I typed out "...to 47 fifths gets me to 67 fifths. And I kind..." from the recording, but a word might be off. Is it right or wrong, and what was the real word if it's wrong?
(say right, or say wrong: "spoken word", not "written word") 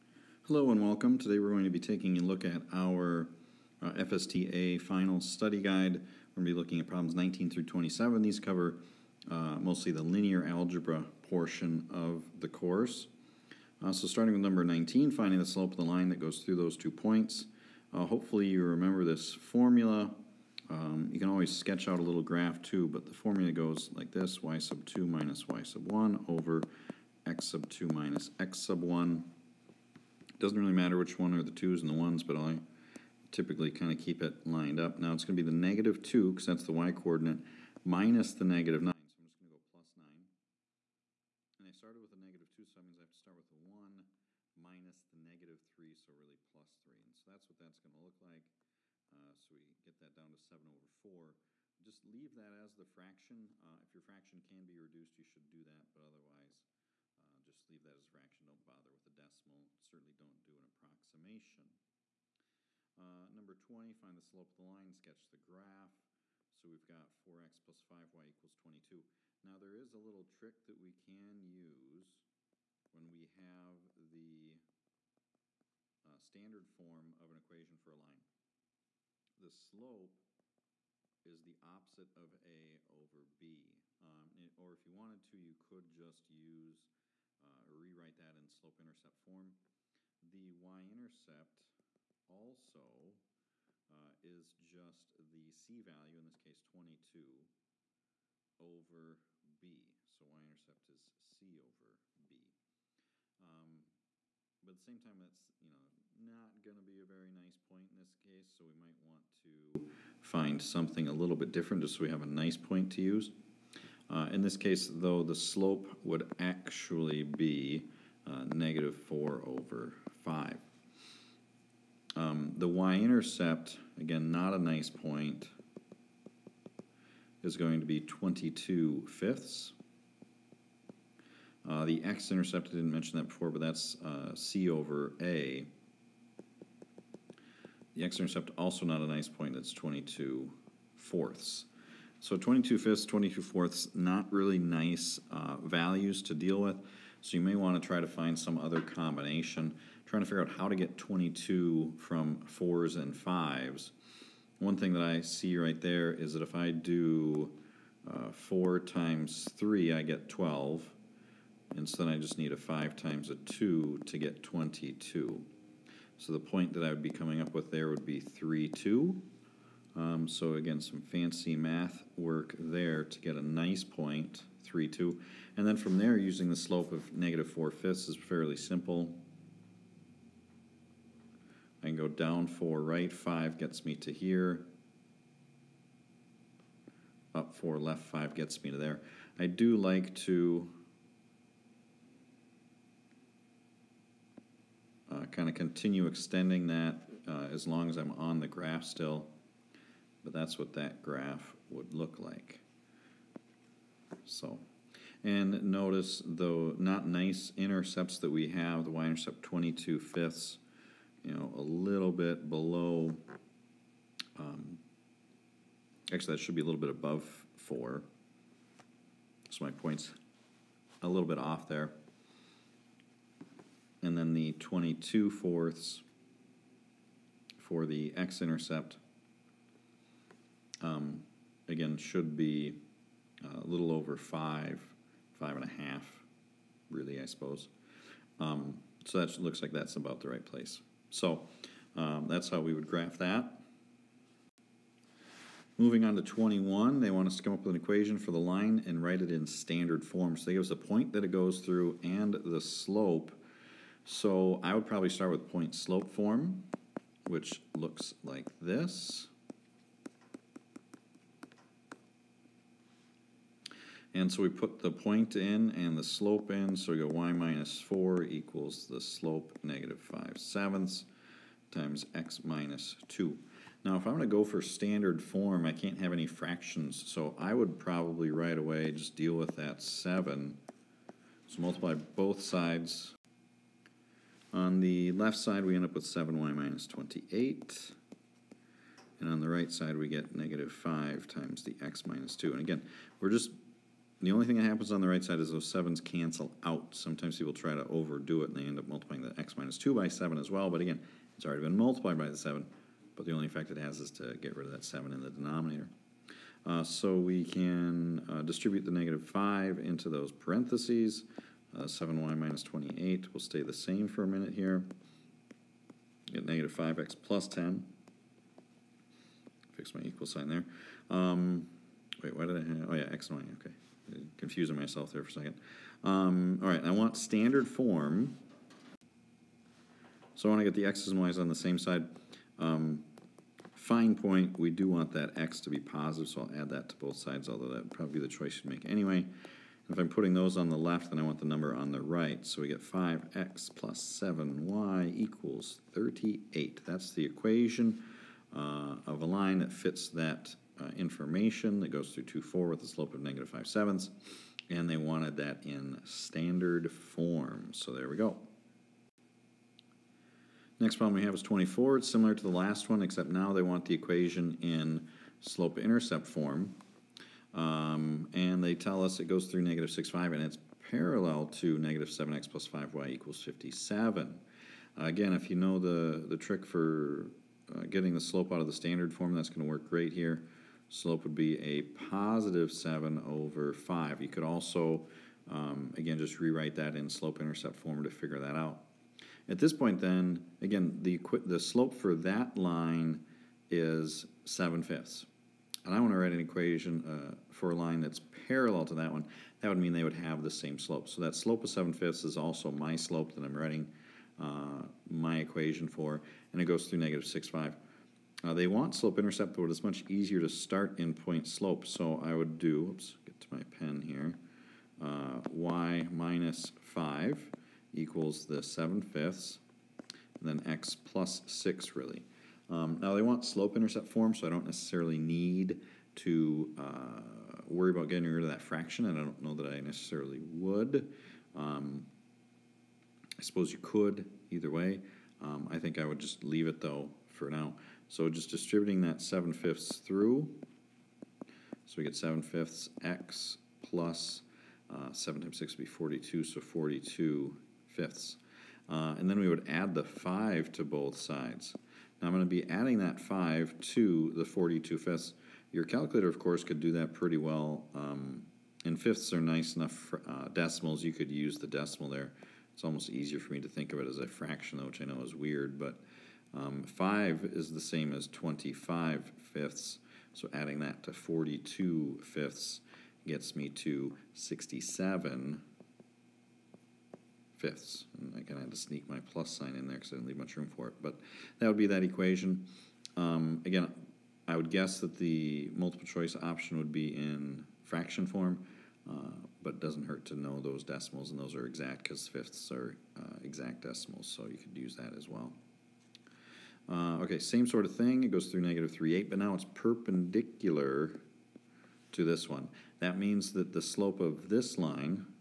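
wrong: "42", not "47".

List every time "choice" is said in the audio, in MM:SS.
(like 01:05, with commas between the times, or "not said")
05:38, 08:06.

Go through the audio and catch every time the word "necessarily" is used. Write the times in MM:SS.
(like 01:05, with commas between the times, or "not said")
07:04, 07:09.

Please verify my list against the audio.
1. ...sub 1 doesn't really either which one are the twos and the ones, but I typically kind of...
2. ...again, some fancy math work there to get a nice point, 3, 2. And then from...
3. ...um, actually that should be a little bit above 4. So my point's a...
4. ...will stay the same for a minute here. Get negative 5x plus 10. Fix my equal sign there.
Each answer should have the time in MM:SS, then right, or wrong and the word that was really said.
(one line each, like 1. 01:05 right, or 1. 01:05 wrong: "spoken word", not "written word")
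1. 00:28 wrong: "matter", not "either"
2. 02:50 right
3. 03:34 right
4. 05:13 right.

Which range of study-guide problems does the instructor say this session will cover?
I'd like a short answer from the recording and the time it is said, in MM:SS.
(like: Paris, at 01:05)
19 through 27, at 00:07.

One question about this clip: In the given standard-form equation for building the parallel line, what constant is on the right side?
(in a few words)
57.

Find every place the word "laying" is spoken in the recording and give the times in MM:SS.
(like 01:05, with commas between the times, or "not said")
not said.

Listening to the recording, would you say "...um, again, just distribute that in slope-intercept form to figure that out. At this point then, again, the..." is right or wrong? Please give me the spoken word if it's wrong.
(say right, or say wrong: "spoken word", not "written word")
wrong: "rewrite", not "distribute".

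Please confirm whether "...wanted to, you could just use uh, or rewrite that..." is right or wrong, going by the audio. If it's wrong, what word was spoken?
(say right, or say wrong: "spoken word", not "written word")
right.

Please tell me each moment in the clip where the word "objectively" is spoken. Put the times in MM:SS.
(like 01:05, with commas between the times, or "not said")
not said.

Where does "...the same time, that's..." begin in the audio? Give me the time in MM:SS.
01:44.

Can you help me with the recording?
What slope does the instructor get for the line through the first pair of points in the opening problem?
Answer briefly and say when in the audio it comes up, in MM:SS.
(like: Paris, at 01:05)
7/4, at 00:50.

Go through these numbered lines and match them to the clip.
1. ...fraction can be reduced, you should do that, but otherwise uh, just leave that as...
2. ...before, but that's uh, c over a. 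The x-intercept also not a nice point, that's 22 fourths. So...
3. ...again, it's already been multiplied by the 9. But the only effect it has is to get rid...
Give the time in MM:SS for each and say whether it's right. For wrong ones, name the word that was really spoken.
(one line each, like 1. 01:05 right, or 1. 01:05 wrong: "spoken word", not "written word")
1. 00:54 right
2. 02:13 right
3. 05:00 wrong: "7", not "9".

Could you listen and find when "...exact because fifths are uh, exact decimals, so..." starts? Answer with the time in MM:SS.
08:11.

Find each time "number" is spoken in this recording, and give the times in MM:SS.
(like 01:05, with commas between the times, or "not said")
00:14, 01:03, 05:41.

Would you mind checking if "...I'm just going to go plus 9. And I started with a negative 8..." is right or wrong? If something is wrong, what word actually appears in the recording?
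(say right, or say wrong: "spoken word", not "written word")
wrong: "2", not "8".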